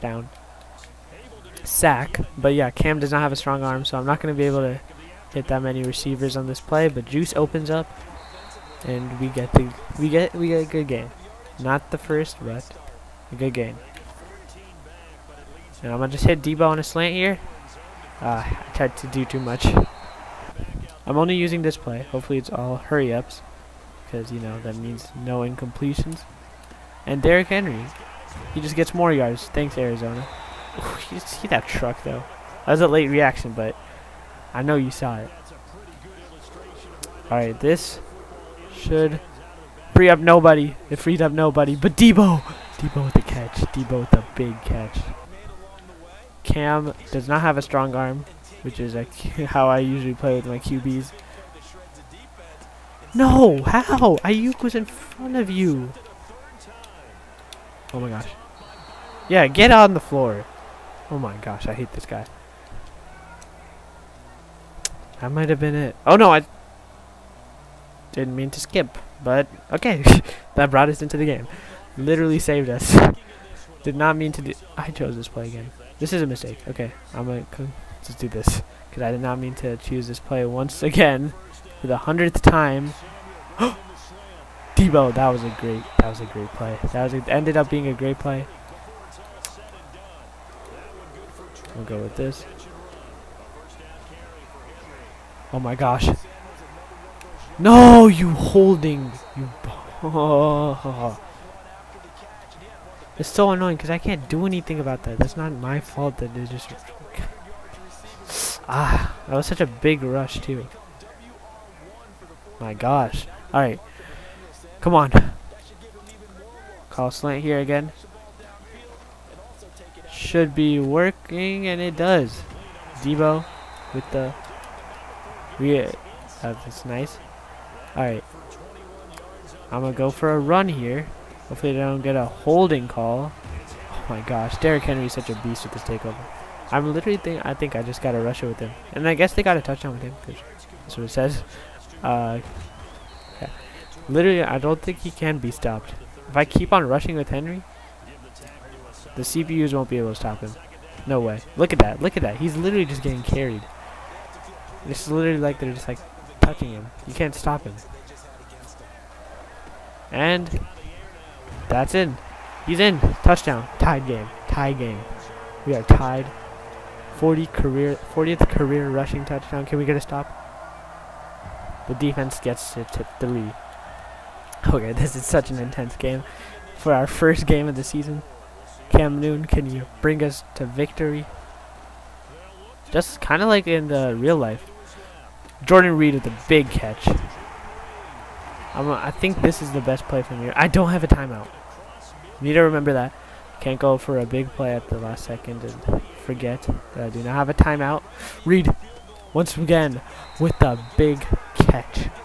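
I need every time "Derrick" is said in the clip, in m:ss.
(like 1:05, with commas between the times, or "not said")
0:27, 2:14.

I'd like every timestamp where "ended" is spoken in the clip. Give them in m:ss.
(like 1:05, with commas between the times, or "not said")
1:27.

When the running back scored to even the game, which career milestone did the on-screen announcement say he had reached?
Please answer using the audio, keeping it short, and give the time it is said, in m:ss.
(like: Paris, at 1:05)
40th career rushing touchdown, at 2:48.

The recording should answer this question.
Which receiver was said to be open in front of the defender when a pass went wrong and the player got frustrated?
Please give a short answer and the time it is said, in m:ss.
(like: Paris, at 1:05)
Aiyuk, at 0:54.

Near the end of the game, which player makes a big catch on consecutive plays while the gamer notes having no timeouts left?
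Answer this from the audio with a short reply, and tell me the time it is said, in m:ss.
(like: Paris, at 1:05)
Jordan Reed, at 3:05.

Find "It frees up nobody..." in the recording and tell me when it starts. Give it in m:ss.
0:40.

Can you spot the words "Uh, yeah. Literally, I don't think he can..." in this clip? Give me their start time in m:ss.
2:22.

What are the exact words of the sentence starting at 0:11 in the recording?
Not the first, but a good game.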